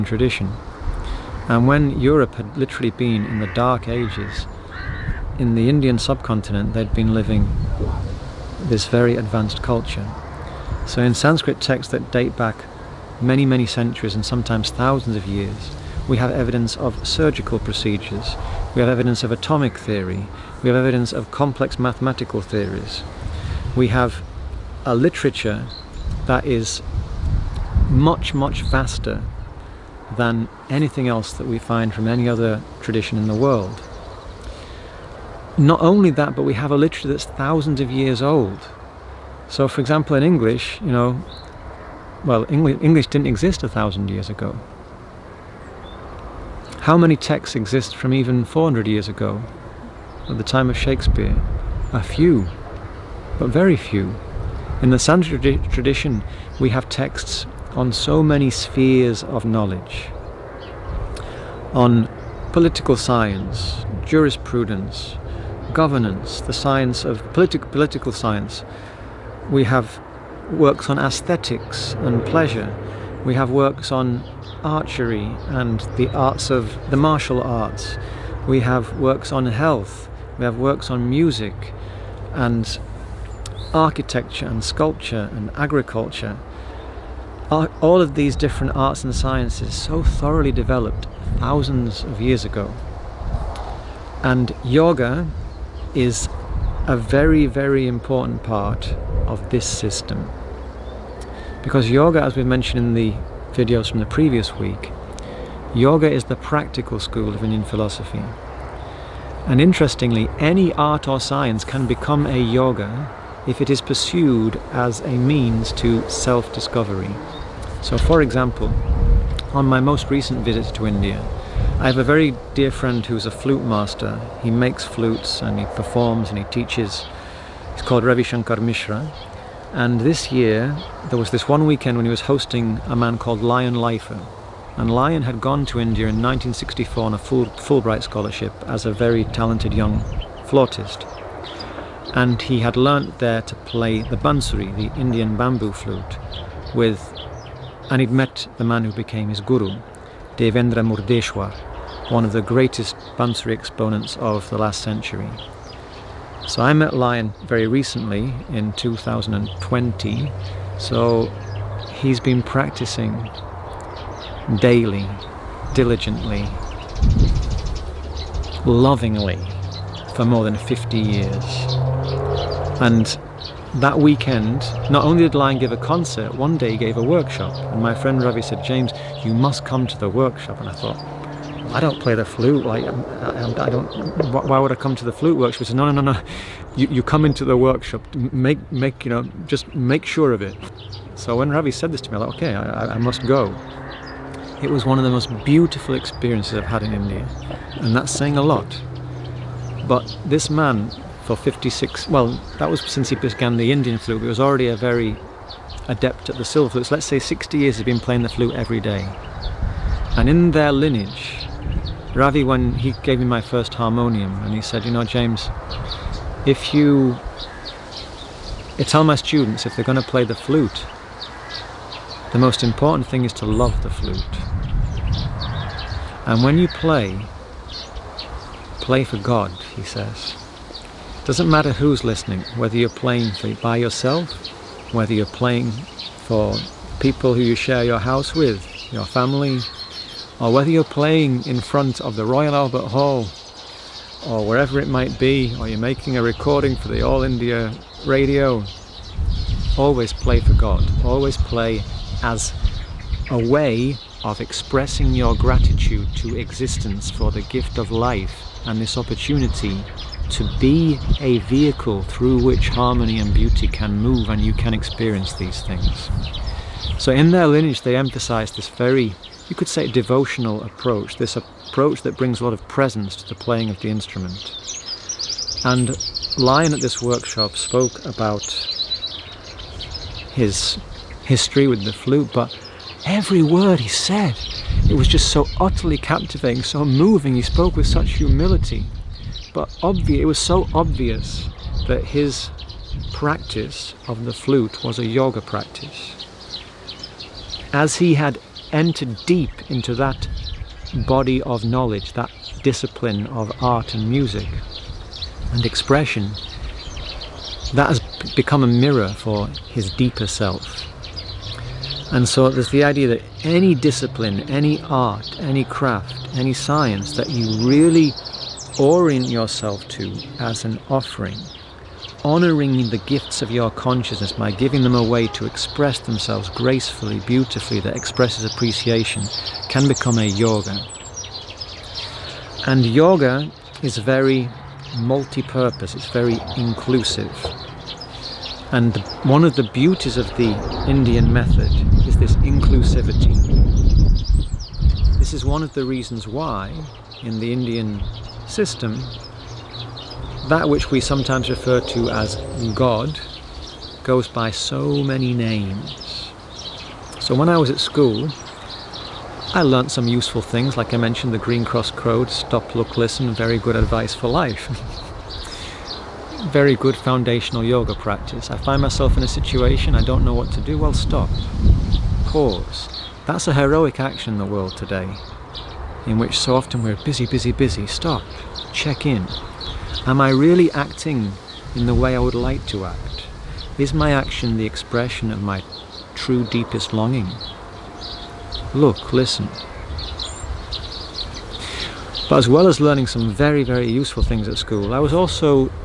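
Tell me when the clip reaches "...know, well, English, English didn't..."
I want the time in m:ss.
0:40.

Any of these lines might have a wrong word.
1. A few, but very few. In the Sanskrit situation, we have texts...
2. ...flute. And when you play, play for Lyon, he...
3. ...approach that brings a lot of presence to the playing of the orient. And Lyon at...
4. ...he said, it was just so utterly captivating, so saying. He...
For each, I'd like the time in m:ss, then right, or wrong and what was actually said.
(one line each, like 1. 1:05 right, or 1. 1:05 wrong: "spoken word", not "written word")
1. 0:51 wrong: "tradition", not "situation"
2. 3:43 wrong: "God", not "Lyon"
3. 4:31 wrong: "instrument", not "orient"
4. 4:43 wrong: "moving", not "saying".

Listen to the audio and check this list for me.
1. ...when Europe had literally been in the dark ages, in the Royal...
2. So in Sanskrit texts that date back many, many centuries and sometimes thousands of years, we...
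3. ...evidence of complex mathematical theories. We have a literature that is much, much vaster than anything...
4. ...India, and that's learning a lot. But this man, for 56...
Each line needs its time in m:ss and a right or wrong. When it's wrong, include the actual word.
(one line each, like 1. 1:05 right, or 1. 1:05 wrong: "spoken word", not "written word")
1. 0:01 wrong: "Indian", not "Royal"
2. 0:10 right
3. 0:20 right
4. 3:16 wrong: "saying", not "learning".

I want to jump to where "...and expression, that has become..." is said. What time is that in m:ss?
5:05.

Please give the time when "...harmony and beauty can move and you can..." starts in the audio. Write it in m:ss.
4:22.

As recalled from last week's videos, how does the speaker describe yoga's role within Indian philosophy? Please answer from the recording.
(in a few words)
The practical school.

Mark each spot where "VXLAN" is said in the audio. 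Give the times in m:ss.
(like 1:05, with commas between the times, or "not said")
not said.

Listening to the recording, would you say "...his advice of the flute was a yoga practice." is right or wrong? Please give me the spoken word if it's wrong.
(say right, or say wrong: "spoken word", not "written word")
wrong: "practice", not "advice".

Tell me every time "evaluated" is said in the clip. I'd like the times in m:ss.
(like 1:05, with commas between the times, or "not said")
not said.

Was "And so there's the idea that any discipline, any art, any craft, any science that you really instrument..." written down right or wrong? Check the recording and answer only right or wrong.
wrong.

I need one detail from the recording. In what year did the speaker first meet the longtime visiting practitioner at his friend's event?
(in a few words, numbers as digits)
2020.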